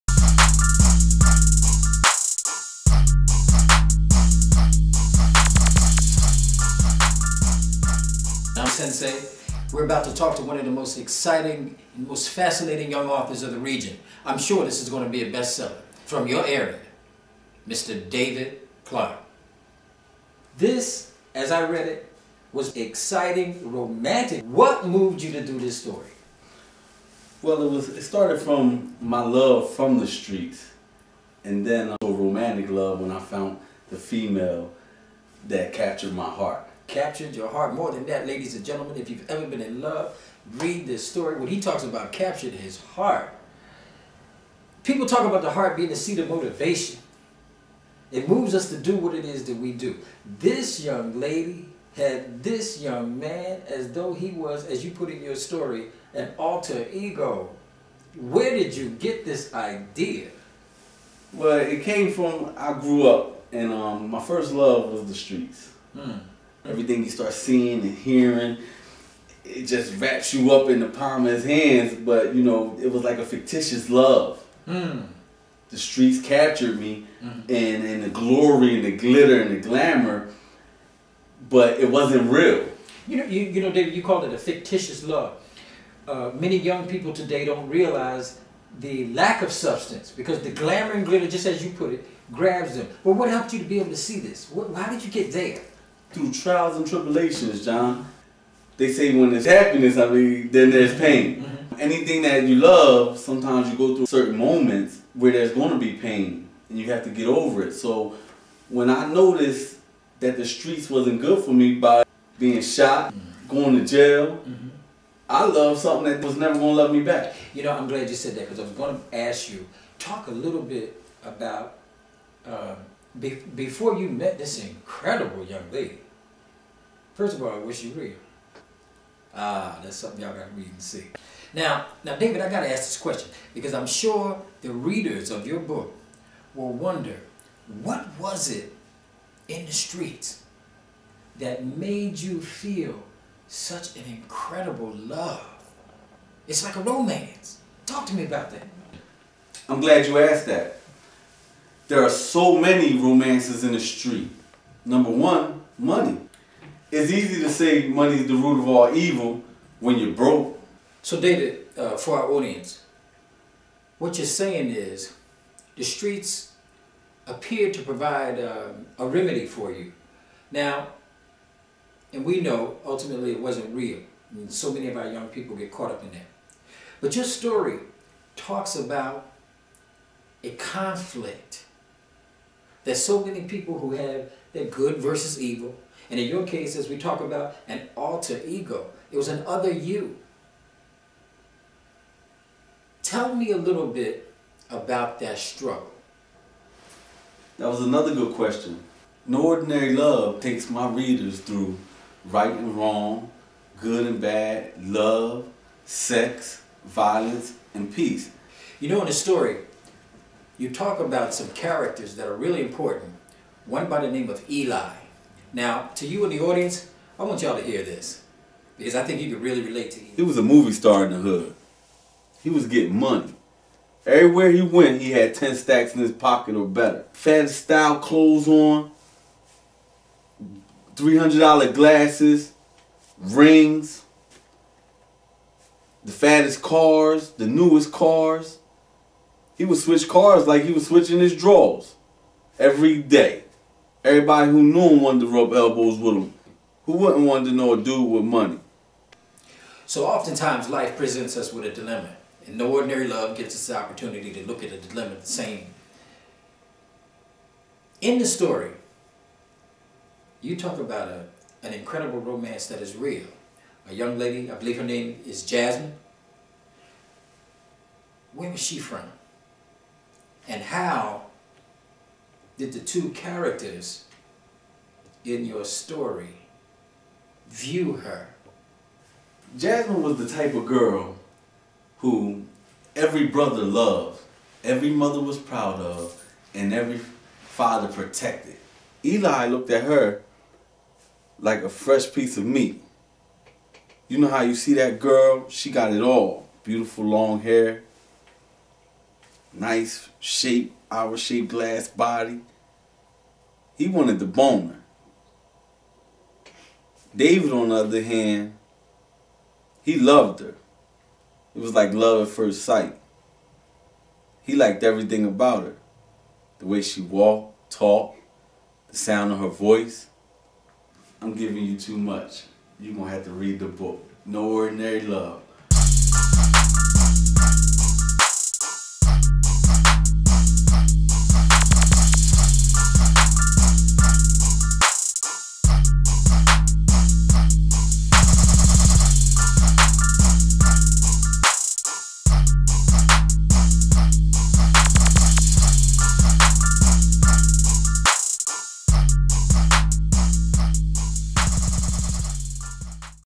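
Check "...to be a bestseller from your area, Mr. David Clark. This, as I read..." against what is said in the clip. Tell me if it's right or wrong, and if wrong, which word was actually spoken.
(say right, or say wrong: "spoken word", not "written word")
right.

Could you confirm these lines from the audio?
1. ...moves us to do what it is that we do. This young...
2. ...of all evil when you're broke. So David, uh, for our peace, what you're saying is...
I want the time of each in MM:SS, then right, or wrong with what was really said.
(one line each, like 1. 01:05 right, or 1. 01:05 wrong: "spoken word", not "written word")
1. 00:48 right
2. 02:38 wrong: "audience", not "peace".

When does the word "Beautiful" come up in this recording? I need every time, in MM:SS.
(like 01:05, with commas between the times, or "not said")
04:56.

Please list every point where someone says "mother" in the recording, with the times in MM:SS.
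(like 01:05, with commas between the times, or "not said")
04:44.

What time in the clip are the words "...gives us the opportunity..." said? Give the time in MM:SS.
04:13.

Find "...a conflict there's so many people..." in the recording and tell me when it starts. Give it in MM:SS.
03:00.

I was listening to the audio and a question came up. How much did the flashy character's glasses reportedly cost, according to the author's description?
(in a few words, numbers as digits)
$300.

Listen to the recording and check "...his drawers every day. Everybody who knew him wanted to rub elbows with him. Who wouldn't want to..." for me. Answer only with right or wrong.
right.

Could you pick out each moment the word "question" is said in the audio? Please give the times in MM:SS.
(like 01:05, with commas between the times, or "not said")
02:12, 03:18.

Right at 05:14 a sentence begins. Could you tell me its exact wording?
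He liked everything about her the way she walked, talked, the sound of her voice.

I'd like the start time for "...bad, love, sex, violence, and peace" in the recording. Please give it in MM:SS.
03:24.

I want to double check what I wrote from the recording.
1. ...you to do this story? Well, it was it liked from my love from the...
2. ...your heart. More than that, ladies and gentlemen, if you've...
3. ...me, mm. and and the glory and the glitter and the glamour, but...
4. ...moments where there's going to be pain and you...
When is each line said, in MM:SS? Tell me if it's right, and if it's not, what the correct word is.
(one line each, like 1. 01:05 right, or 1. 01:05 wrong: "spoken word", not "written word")
1. 00:25 wrong: "started", not "liked"
2. 00:37 right
3. 01:16 right
4. 01:44 right.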